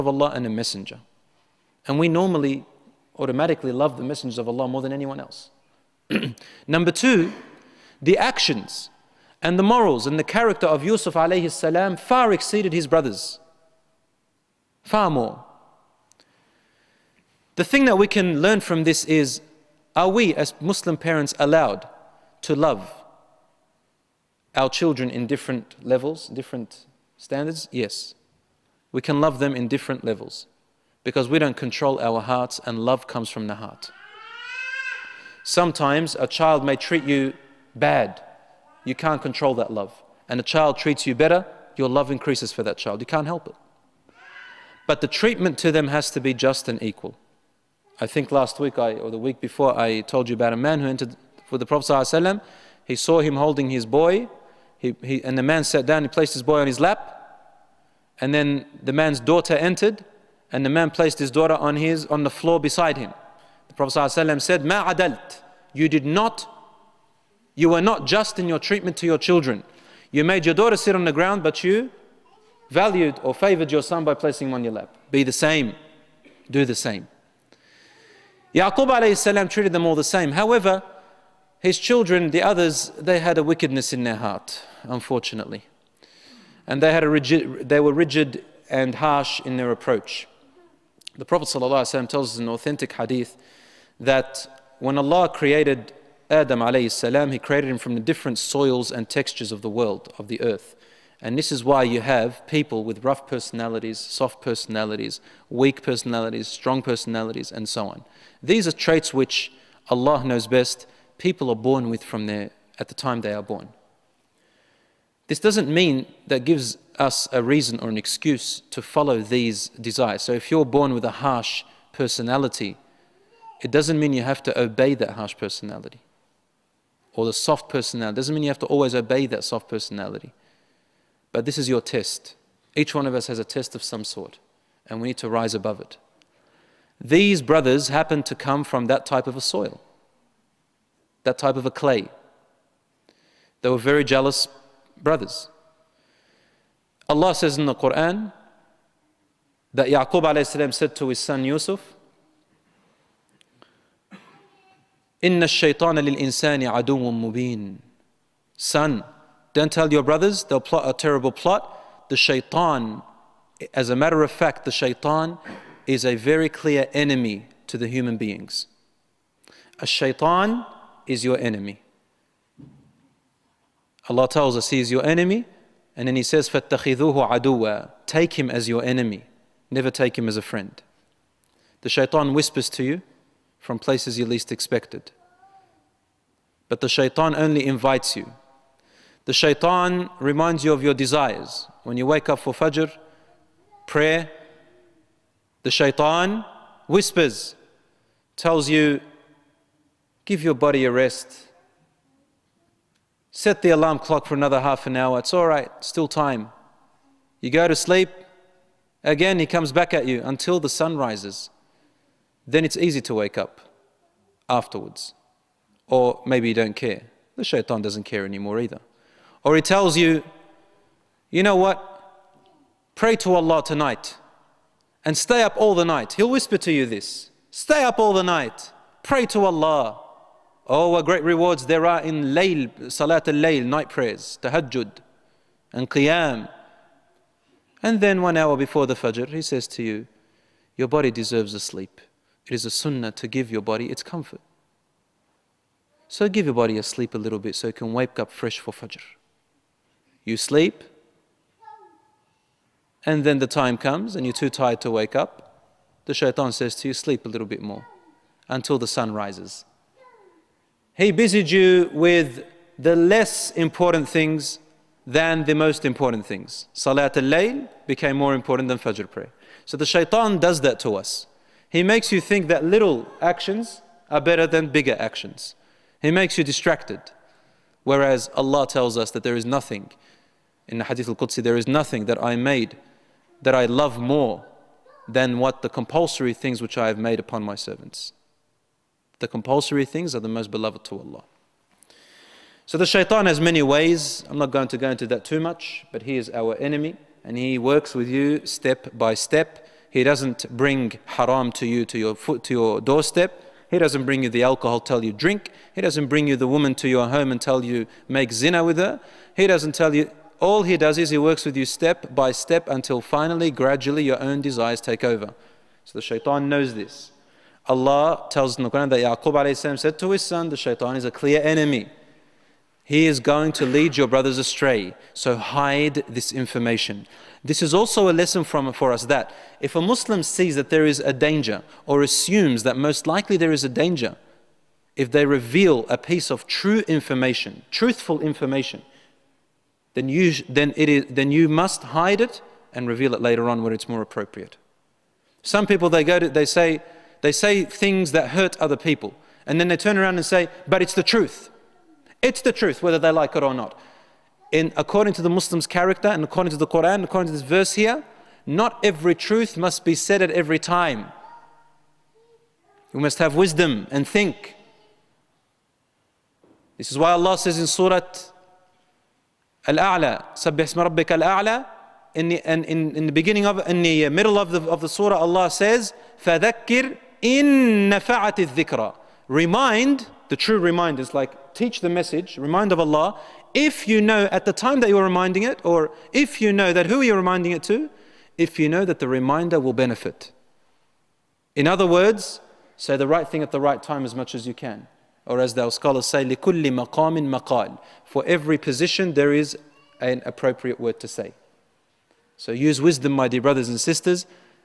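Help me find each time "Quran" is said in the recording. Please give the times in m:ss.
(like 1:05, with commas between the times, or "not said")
2:27, 5:18, 5:56.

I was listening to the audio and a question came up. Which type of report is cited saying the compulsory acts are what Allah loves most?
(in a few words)
Hadith al Qudsi.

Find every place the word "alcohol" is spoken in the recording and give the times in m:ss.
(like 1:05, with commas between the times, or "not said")
5:04.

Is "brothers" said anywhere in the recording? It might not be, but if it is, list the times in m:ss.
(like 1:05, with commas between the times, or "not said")
0:12, 2:17, 2:25, 2:40, 5:24, 6:43.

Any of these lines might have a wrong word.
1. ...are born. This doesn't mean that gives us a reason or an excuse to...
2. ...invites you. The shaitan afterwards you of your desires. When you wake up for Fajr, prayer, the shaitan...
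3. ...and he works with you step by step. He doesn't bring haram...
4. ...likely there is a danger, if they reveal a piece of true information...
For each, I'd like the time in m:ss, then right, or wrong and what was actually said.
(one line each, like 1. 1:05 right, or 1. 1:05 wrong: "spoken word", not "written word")
1. 1:53 right
2. 3:07 wrong: "reminds", not "afterwards"
3. 4:57 right
4. 5:33 right.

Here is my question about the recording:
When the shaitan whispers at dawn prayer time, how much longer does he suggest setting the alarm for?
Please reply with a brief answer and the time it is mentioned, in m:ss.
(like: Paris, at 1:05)
Half an hour, at 3:24.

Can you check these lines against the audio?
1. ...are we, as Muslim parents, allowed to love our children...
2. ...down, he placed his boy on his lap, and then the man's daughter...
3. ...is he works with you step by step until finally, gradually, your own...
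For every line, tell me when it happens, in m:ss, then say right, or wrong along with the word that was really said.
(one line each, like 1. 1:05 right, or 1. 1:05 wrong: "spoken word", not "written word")
1. 0:19 right
2. 0:55 right
3. 5:10 right.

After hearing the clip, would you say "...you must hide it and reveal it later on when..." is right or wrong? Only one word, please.
right.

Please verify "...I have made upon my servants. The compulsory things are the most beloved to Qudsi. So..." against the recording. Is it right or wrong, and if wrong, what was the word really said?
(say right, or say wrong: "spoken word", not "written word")
wrong: "Allah", not "Qudsi".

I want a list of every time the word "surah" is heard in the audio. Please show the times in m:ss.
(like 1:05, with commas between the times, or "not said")
6:07, 6:14.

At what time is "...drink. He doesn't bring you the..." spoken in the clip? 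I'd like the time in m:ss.
5:05.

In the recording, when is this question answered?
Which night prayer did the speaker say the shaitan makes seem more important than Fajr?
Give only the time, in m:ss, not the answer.
4:26.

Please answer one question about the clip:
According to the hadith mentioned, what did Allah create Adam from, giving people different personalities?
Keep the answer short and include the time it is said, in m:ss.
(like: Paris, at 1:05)
Different soils and textures, at 1:38.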